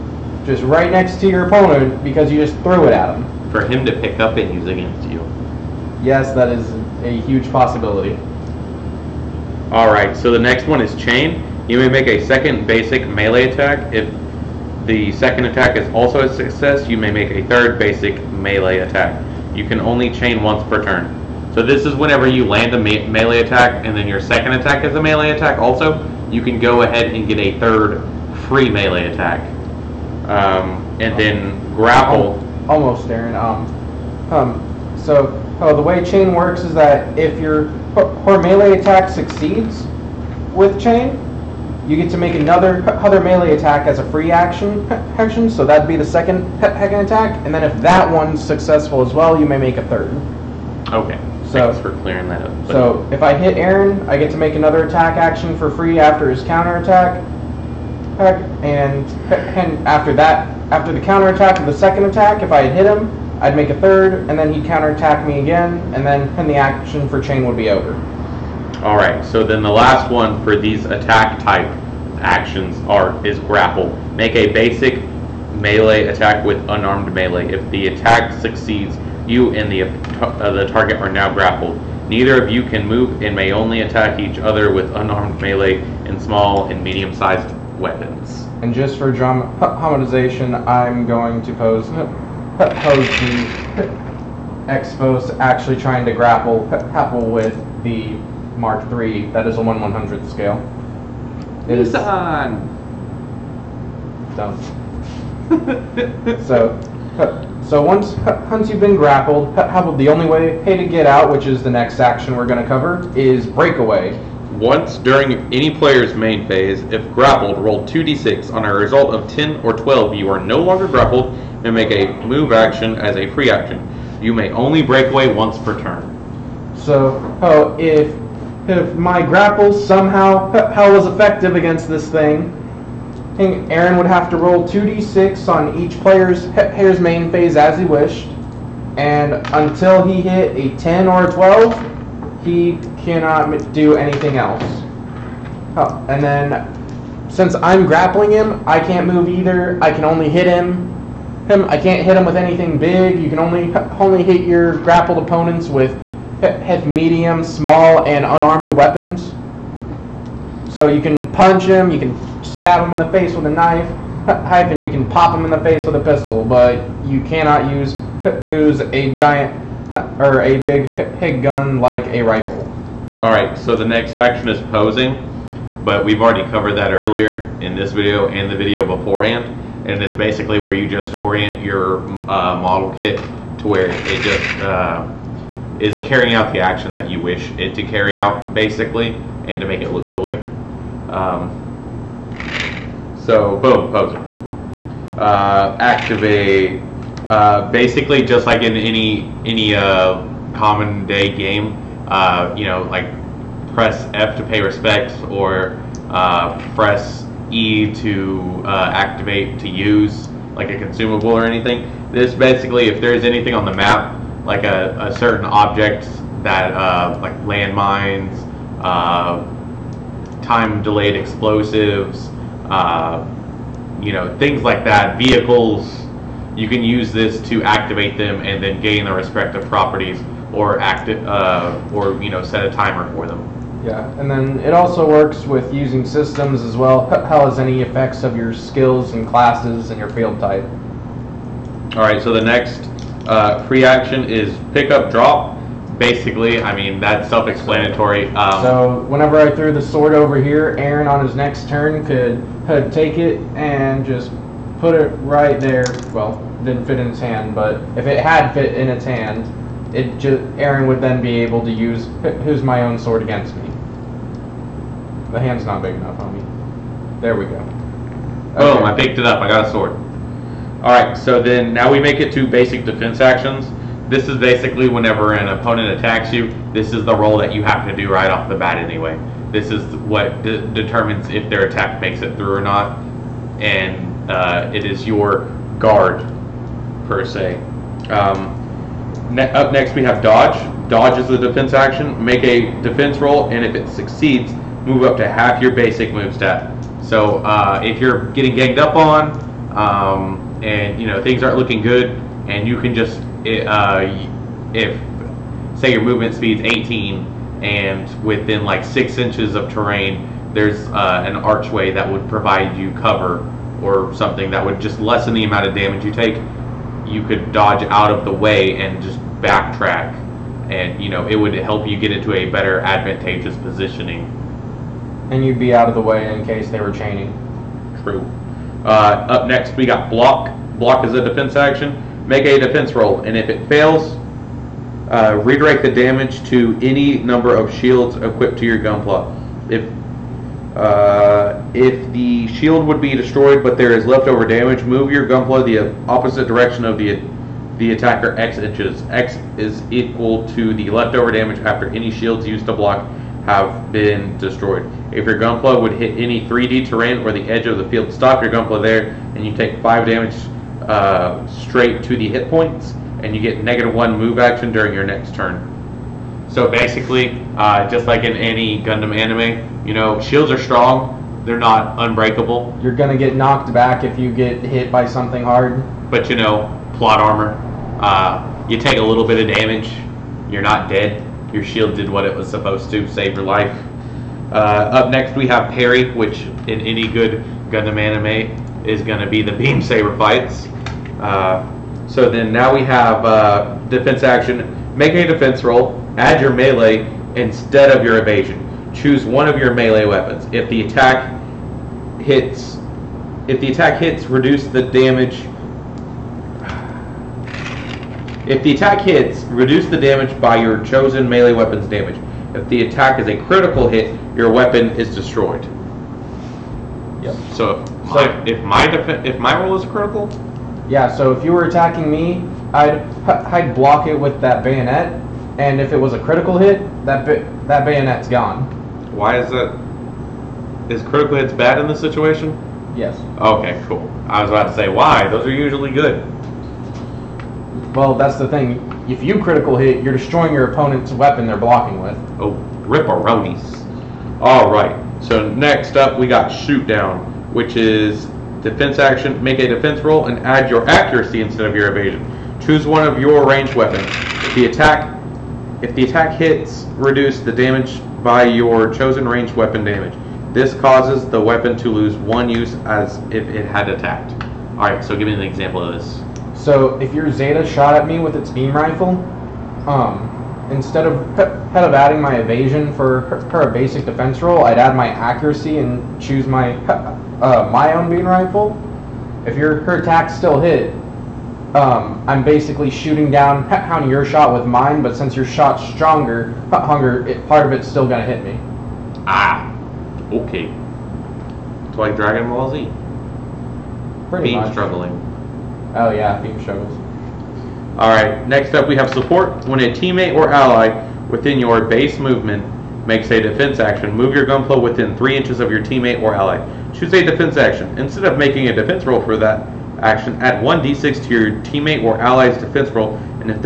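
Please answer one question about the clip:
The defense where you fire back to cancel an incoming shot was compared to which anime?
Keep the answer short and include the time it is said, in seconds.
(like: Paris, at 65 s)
Dragon Ball Z, at 492 s.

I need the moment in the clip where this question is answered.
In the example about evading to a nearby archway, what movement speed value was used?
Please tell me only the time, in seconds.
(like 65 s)
306 s.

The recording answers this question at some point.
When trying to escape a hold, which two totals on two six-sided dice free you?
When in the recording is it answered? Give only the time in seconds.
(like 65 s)
119 s.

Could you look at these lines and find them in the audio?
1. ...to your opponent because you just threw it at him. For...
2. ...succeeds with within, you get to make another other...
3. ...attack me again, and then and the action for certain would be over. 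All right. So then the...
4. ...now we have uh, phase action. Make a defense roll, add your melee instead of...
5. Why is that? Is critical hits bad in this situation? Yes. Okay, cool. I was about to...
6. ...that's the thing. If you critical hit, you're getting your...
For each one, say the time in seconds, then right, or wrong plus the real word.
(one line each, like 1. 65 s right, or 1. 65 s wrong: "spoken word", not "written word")
1. 1 s right
2. 39 s wrong: "chain", not "within"
3. 64 s wrong: "chain", not "certain"
4. 392 s wrong: "defense", not "phase"
5. 429 s right
6. 438 s wrong: "destroying", not "getting".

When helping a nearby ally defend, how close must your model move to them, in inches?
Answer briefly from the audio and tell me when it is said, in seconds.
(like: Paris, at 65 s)
3, at 505 s.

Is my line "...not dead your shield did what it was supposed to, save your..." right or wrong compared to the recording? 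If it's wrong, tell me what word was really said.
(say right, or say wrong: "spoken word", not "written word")
right.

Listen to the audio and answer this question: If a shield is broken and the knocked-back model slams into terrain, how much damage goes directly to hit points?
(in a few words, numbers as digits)
5.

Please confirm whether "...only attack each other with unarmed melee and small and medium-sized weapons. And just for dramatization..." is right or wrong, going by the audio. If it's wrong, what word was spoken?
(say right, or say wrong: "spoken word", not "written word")
right.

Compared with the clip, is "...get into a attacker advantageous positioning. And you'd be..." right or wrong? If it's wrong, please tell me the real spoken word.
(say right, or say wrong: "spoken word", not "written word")
wrong: "better", not "attacker".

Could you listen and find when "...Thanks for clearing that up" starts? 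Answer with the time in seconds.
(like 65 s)
51 s.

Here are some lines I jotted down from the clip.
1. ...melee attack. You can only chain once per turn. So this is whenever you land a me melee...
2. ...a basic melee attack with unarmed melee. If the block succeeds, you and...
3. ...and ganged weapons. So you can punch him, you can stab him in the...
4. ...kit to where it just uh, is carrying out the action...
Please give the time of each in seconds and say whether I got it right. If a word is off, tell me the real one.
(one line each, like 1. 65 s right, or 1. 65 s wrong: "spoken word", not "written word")
1. 18 s right
2. 74 s wrong: "attack", not "block"
3. 158 s wrong: "unarmed", not "ganged"
4. 182 s right.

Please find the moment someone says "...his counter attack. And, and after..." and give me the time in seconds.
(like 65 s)
56 s.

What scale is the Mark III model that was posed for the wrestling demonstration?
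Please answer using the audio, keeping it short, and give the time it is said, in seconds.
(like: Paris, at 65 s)
1/100, at 99 s.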